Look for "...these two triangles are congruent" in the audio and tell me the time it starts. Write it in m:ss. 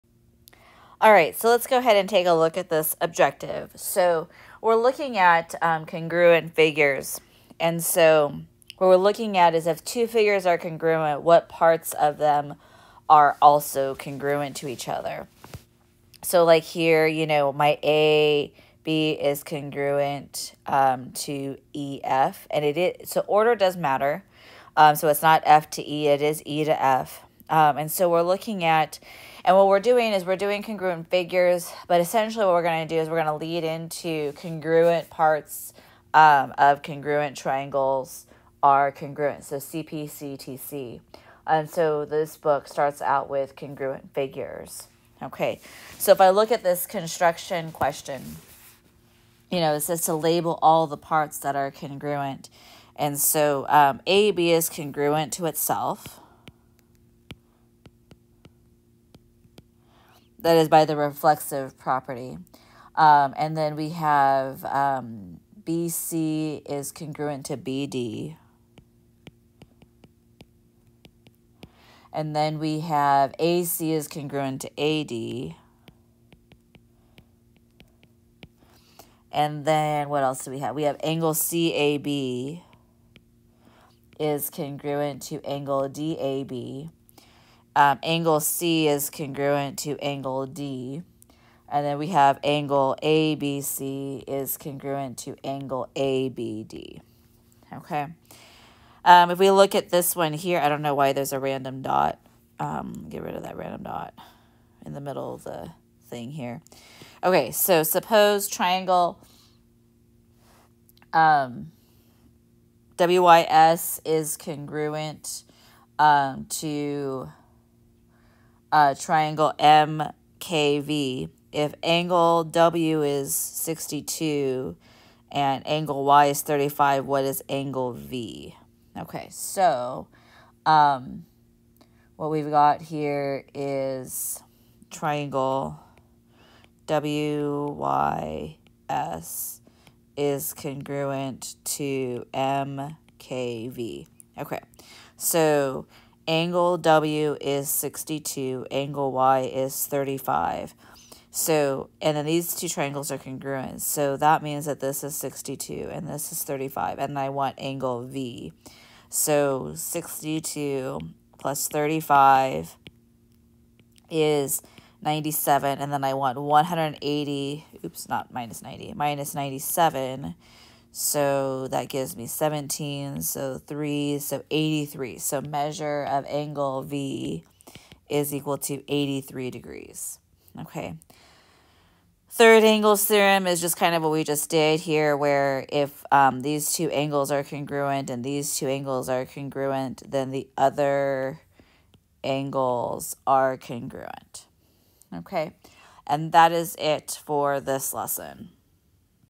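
2:32.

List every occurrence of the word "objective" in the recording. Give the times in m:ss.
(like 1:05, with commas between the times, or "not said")
0:03.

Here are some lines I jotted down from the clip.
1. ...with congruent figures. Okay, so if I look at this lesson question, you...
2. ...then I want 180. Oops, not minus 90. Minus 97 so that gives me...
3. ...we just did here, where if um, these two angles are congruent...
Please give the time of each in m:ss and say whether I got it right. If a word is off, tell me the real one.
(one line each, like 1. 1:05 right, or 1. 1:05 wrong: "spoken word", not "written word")
1. 0:43 wrong: "construction", not "lesson"
2. 2:45 right
3. 3:04 right.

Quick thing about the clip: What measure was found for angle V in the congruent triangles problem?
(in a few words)
83 degrees.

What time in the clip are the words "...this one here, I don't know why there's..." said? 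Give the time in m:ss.
1:39.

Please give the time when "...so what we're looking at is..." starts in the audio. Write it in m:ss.
0:07.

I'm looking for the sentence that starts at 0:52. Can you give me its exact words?
And so um, AB is congruent to itself.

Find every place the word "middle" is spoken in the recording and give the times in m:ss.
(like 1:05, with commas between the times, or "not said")
1:44.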